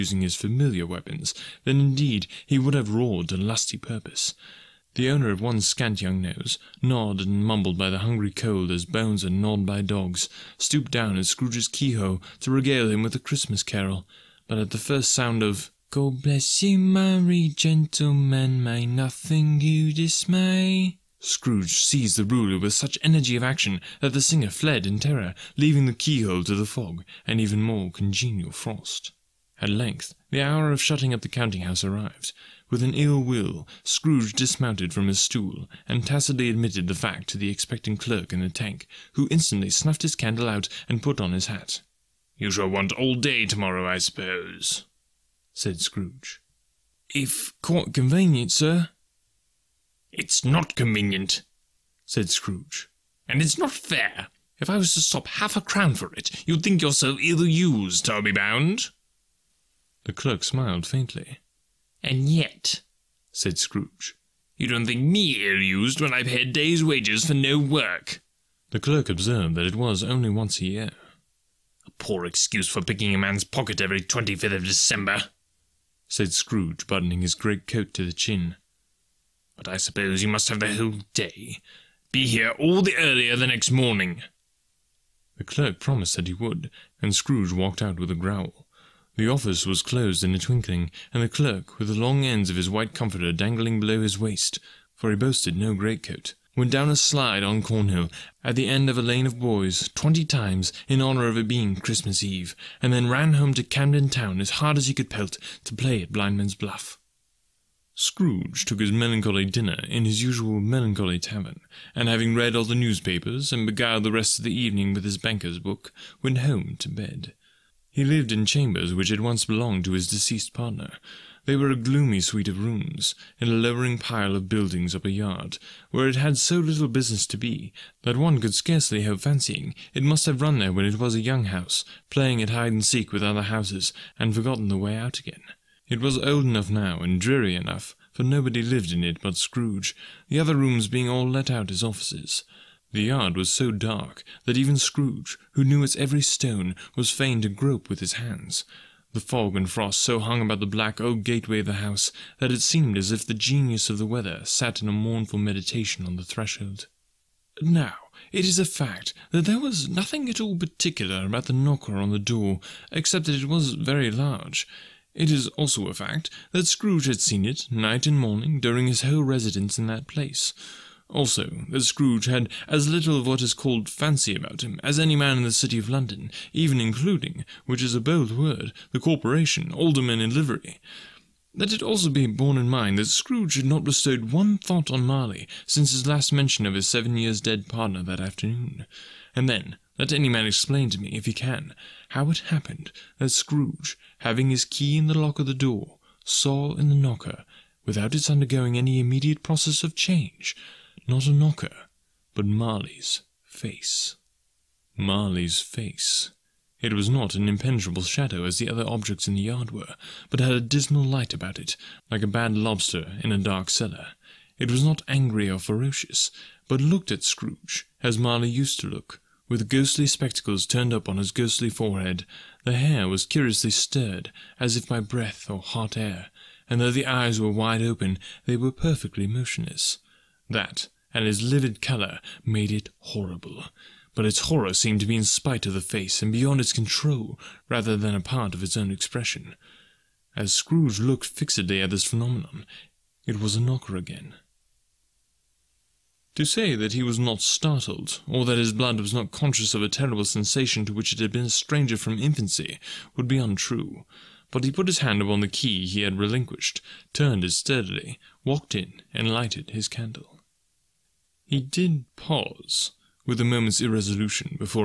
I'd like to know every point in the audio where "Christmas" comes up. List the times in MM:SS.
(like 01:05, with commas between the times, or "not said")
00:13, 01:41.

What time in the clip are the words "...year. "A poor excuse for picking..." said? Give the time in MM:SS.
01:10.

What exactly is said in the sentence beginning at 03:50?
That, and his livid colour, made it horrible.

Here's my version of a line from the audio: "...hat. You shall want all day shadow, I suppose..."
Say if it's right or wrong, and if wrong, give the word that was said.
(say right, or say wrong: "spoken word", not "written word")
wrong: "tomorrow", not "shadow".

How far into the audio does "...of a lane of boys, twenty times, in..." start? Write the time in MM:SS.
01:38.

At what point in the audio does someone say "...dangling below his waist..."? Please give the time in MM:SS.
01:33.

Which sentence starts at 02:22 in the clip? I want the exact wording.
The yard was so dark that even Scrooge, who knew its every stone, was fain to grope with his hands.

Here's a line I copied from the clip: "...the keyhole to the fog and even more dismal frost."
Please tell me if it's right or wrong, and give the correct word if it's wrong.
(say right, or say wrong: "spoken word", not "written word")
wrong: "congenial", not "dismal".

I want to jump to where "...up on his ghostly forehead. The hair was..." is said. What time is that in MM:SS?
03:40.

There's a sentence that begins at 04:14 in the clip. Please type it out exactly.
But he put his hand upon the key he had relinquished, turned it steadily, walked in, and lighted his candle.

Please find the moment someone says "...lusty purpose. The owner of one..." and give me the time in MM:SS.
00:03.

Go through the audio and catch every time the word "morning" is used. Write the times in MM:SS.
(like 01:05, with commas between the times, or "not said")
01:23, 02:48.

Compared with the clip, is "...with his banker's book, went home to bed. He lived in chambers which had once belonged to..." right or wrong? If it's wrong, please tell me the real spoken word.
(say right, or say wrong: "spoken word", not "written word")
right.